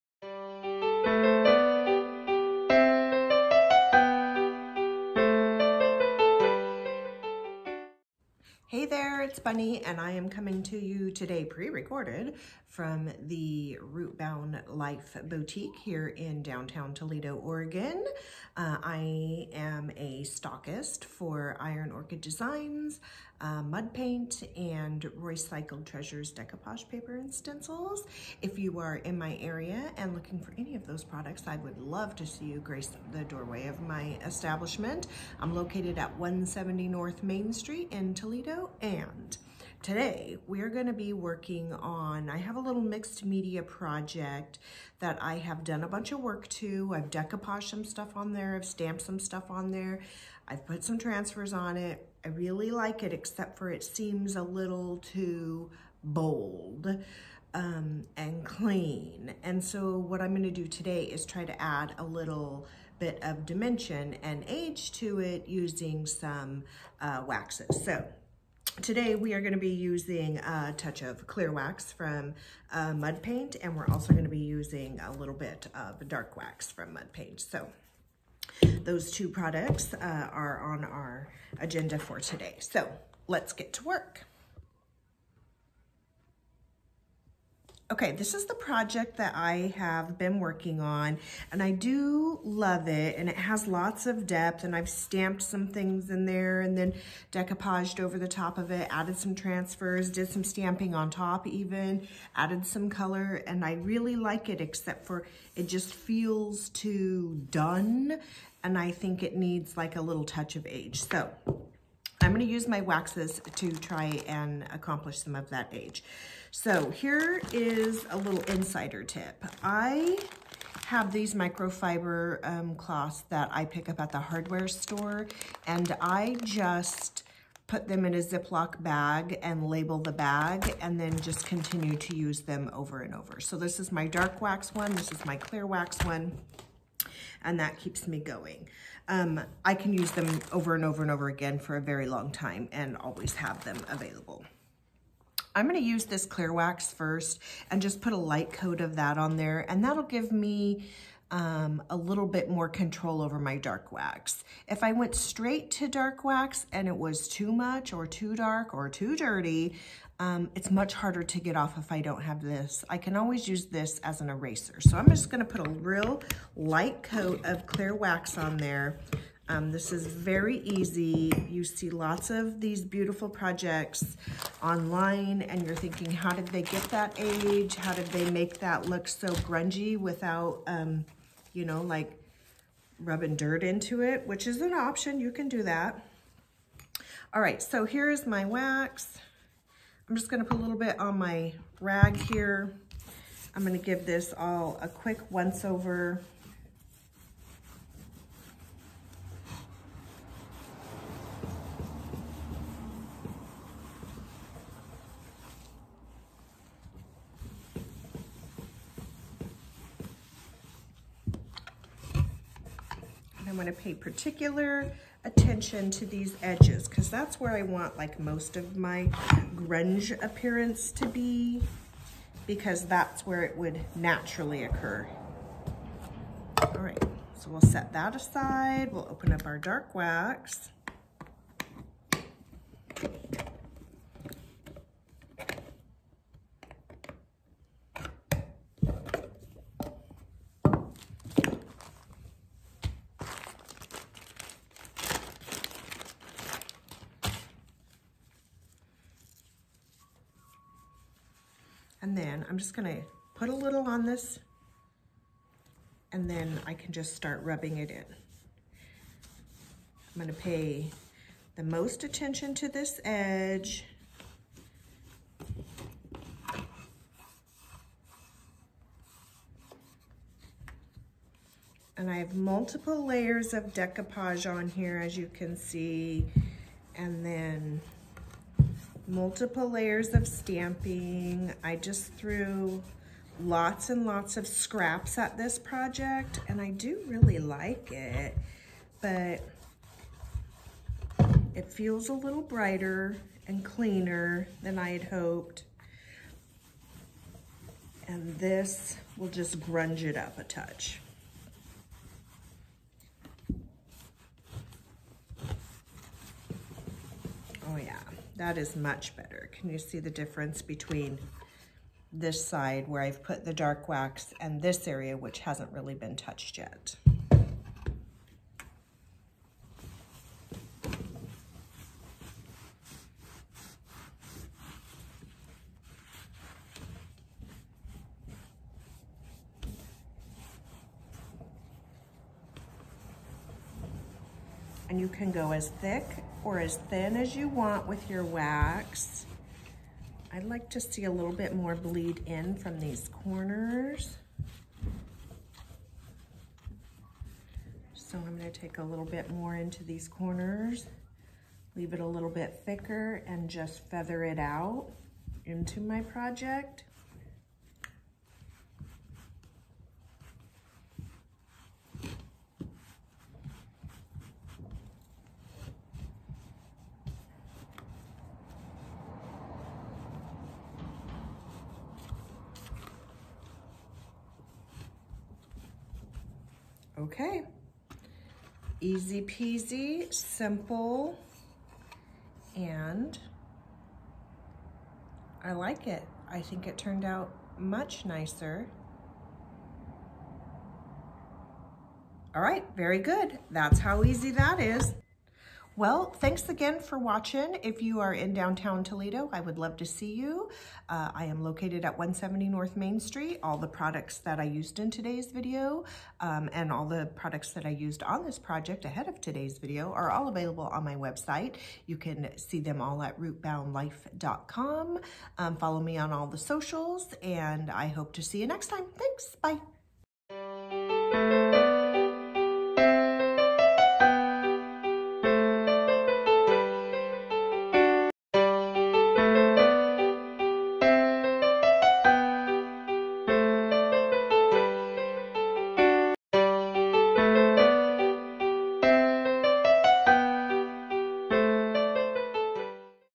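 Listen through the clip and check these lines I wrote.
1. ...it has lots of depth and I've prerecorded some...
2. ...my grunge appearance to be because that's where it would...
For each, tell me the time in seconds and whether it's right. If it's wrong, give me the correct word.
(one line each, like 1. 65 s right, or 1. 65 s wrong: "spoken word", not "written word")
1. 93 s wrong: "stamped", not "prerecorded"
2. 218 s right.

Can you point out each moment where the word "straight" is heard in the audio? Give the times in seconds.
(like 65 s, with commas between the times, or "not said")
155 s.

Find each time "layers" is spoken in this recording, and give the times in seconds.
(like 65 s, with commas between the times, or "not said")
273 s, 279 s.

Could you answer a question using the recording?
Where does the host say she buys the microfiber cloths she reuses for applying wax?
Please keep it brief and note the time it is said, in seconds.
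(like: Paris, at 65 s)
hardware store, at 124 s.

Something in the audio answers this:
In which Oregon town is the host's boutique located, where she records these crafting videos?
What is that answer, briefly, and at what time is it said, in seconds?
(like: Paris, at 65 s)
Toledo, Oregon, at 16 s.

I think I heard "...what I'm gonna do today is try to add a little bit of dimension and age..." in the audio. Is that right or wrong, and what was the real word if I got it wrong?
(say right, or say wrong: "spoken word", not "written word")
right.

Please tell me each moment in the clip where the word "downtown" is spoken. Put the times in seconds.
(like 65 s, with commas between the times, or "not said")
16 s, 398 s.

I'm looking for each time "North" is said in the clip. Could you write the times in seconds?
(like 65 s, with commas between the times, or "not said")
36 s, 402 s.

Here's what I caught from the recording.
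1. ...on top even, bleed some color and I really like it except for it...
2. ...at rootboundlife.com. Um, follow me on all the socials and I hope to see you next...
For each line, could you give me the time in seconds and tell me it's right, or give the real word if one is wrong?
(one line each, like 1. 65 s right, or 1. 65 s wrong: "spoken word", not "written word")
1. 100 s wrong: "added", not "bleed"
2. 413 s right.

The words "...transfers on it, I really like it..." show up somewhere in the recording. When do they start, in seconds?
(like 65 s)
50 s.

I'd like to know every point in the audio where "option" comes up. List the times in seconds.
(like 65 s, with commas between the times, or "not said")
184 s.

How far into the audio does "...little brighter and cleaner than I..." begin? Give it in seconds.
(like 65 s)
292 s.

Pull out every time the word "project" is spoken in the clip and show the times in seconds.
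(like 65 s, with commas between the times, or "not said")
43 s, 88 s, 173 s, 285 s, 356 s, 408 s.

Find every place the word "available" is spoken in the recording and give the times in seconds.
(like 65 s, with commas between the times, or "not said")
143 s, 410 s.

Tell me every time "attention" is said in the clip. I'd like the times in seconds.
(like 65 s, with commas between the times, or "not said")
215 s, 262 s.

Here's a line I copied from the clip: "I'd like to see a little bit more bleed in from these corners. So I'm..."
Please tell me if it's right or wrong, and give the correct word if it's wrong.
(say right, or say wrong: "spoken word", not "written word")
right.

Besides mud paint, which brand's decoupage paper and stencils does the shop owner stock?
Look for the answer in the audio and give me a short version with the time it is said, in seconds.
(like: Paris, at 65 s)
Roycycled Treasures, at 25 s.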